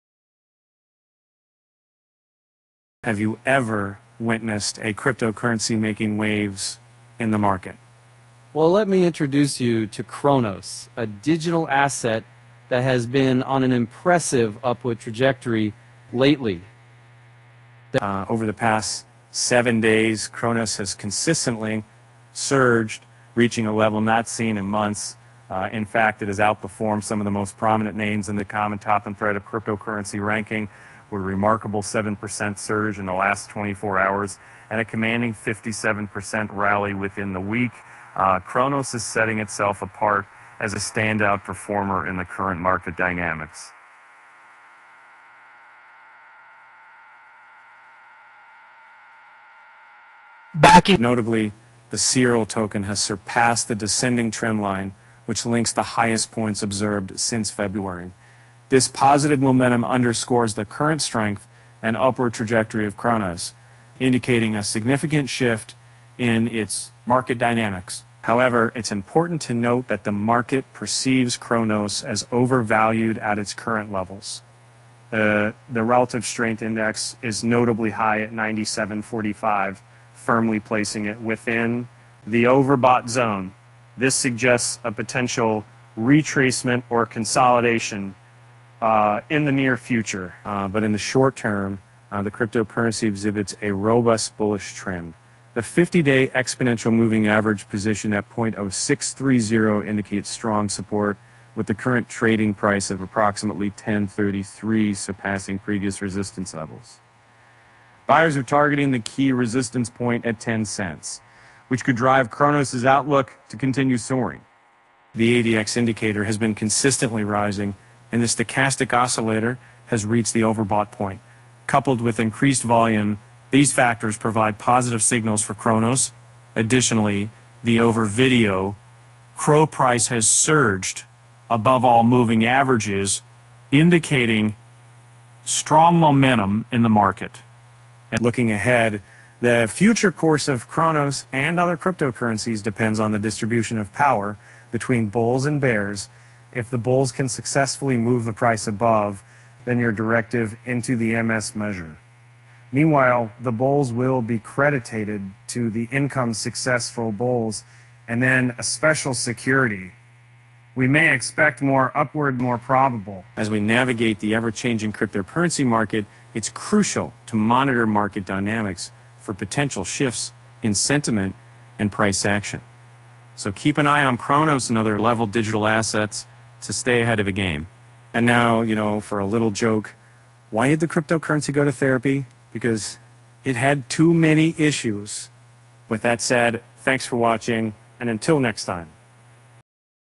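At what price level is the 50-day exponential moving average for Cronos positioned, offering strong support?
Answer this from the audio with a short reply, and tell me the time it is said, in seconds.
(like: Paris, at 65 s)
0.0630, at 98 s.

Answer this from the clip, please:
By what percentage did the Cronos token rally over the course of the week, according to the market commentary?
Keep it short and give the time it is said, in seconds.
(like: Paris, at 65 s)
57%, at 35 s.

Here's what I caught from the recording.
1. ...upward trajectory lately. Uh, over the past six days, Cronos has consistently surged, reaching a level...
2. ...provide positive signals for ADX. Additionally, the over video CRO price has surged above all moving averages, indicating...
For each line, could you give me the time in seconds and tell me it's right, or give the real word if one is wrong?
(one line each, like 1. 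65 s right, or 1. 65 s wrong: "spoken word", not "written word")
1. 14 s wrong: "seven", not "six"
2. 124 s wrong: "Cronos", not "ADX".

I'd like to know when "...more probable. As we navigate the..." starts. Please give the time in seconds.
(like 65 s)
162 s.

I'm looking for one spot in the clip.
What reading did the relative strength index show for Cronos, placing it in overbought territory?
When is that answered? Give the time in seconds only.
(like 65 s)
78 s.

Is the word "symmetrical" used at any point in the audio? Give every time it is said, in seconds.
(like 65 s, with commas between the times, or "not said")
not said.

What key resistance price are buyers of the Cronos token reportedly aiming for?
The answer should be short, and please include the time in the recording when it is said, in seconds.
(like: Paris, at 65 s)
10 cents, at 110 s.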